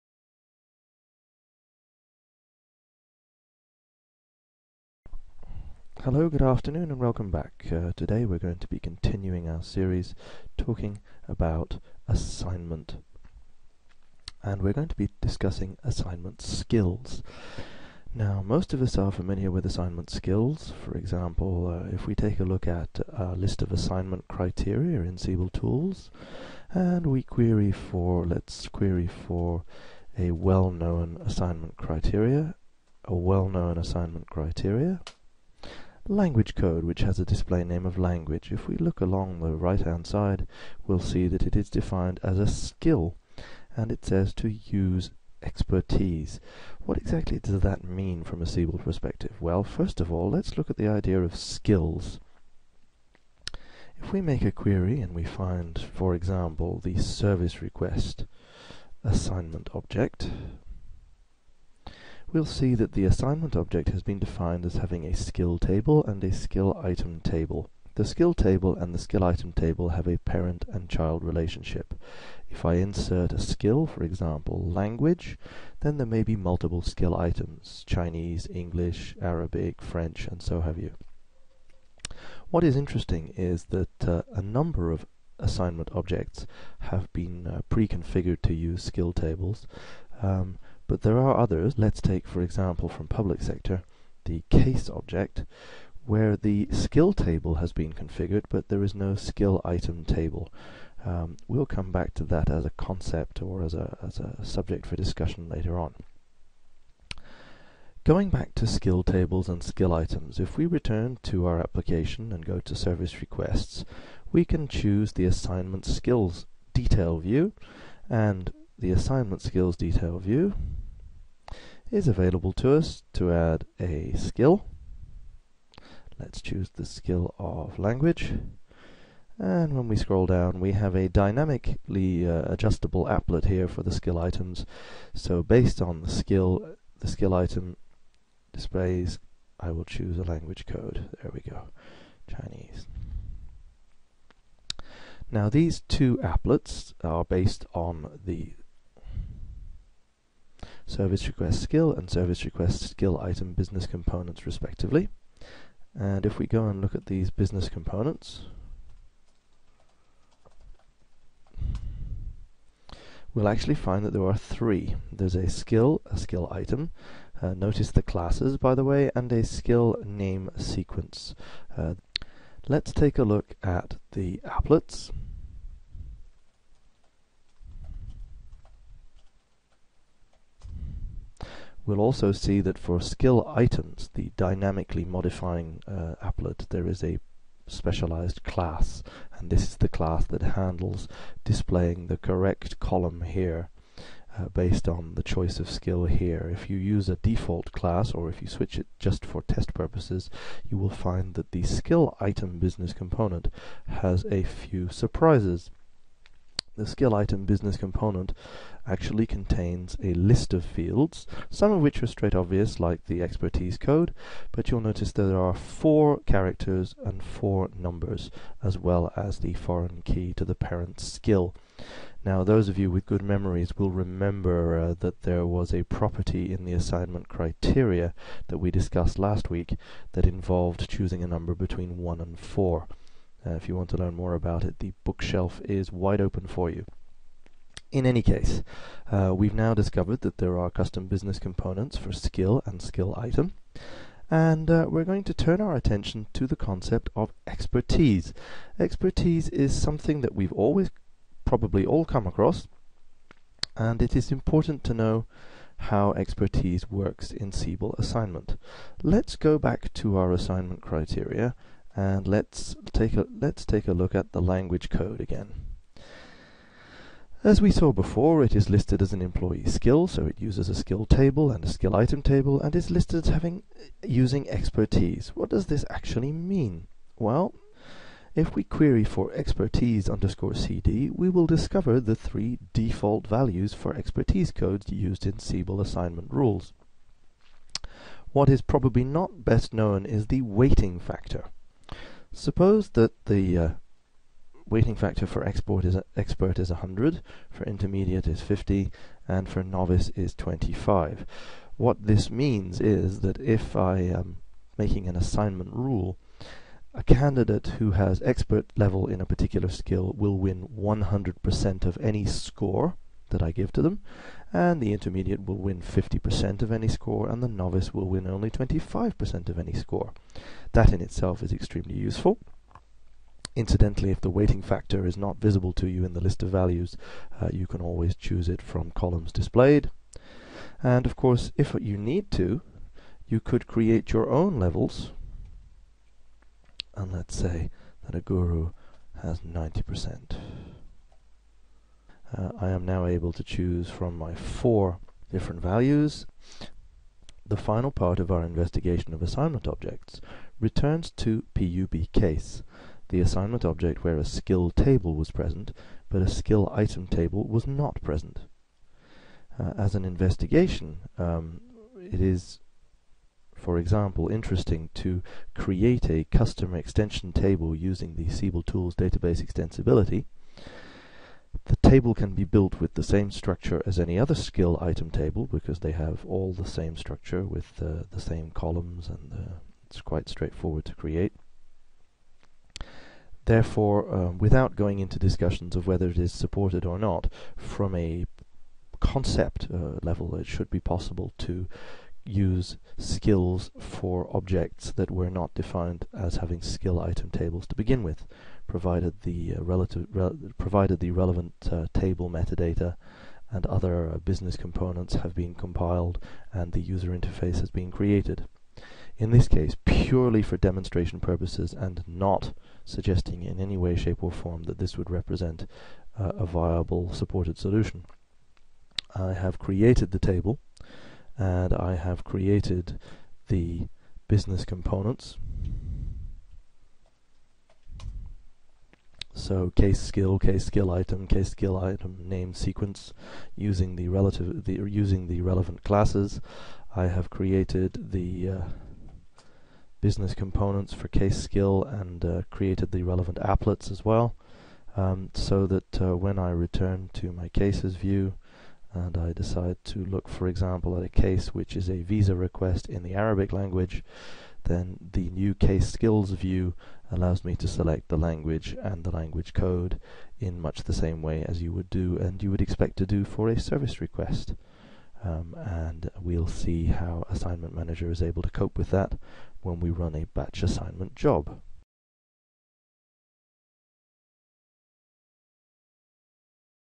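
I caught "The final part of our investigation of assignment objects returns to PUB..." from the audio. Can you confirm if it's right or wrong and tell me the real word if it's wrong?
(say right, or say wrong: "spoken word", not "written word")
right.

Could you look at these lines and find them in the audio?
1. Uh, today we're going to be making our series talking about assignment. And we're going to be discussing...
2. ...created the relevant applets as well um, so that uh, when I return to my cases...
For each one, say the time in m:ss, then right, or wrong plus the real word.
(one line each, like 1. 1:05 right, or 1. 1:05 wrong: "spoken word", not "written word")
1. 0:07 wrong: "continuing", not "making"
2. 7:22 right.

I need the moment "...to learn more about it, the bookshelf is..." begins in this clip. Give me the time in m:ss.
3:53.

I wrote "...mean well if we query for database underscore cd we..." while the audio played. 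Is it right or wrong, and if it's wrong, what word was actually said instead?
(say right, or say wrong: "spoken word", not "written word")
wrong: "expertise", not "database".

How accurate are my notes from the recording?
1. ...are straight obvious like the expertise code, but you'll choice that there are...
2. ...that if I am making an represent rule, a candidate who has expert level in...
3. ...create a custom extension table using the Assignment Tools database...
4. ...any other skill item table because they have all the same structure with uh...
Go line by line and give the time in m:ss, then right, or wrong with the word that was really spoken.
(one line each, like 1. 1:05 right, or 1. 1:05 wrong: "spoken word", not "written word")
1. 3:32 wrong: "notice", not "choice"
2. 5:03 wrong: "assignment", not "represent"
3. 6:05 wrong: "Siebel", not "Assignment"
4. 6:13 right.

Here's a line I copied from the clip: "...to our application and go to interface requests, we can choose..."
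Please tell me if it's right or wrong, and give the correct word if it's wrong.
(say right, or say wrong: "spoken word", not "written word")
wrong: "service", not "interface".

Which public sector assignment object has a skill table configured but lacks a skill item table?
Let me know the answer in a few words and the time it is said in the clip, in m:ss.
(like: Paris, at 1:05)
case object, at 1:34.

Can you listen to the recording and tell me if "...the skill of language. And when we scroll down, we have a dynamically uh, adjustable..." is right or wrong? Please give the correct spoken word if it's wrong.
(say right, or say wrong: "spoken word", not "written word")
right.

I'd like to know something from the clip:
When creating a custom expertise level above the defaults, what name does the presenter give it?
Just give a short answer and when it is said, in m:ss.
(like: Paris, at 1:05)
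guru, at 5:38.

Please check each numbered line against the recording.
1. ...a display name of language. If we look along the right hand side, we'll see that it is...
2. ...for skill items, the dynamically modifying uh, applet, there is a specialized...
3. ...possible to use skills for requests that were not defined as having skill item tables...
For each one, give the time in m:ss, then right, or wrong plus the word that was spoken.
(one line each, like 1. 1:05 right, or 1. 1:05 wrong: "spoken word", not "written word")
1. 0:37 right
2. 3:02 right
3. 6:30 wrong: "objects", not "requests".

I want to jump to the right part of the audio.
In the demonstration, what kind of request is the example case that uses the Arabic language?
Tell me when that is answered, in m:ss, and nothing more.
7:32.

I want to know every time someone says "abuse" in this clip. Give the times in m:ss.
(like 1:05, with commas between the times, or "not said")
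not said.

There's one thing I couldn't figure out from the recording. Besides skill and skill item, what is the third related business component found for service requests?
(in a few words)
skill name sequence.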